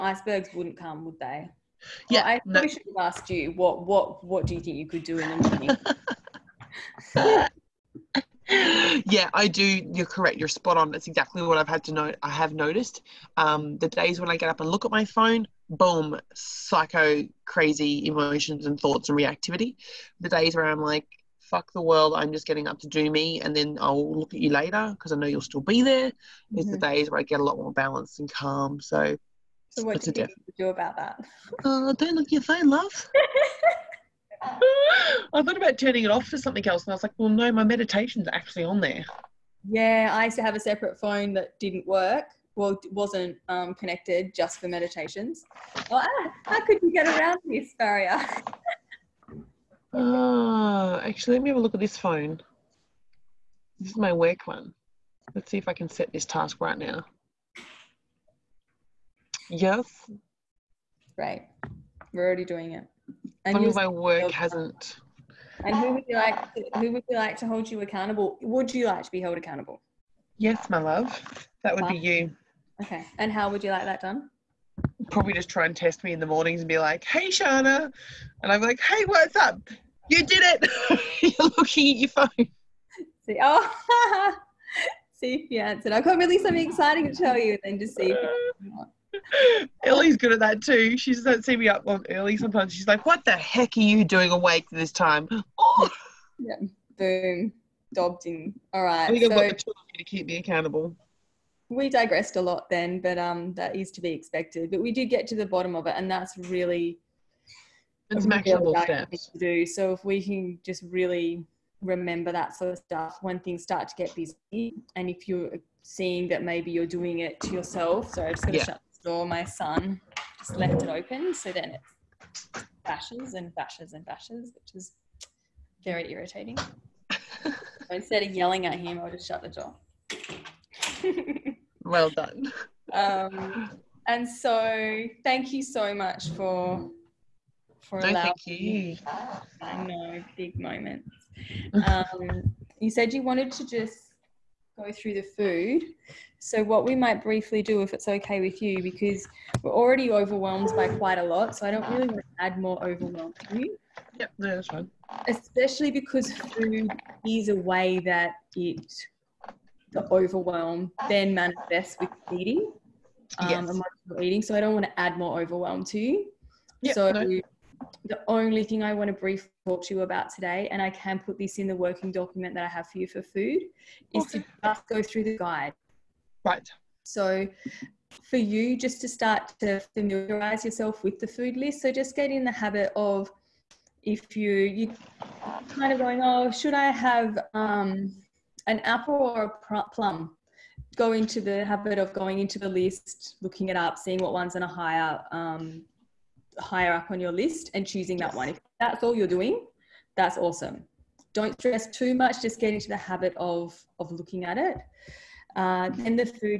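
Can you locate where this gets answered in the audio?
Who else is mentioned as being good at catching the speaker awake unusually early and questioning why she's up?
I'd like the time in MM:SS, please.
01:29.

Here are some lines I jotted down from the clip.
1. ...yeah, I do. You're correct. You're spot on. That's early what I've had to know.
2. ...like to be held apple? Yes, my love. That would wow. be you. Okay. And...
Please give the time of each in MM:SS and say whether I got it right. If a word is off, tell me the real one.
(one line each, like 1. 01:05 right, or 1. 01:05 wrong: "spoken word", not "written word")
1. 00:08 wrong: "exactly", not "early"
2. 01:08 wrong: "accountable", not "apple".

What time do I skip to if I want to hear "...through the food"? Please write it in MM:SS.
02:24.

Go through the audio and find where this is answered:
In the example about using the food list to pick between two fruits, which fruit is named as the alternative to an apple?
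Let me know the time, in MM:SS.
03:09.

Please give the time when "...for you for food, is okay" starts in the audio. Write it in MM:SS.
02:52.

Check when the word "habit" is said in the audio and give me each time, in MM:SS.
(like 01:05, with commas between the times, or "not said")
03:02, 03:11, 03:22.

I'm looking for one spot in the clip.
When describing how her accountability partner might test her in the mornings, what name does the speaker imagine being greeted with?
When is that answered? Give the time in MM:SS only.
01:17.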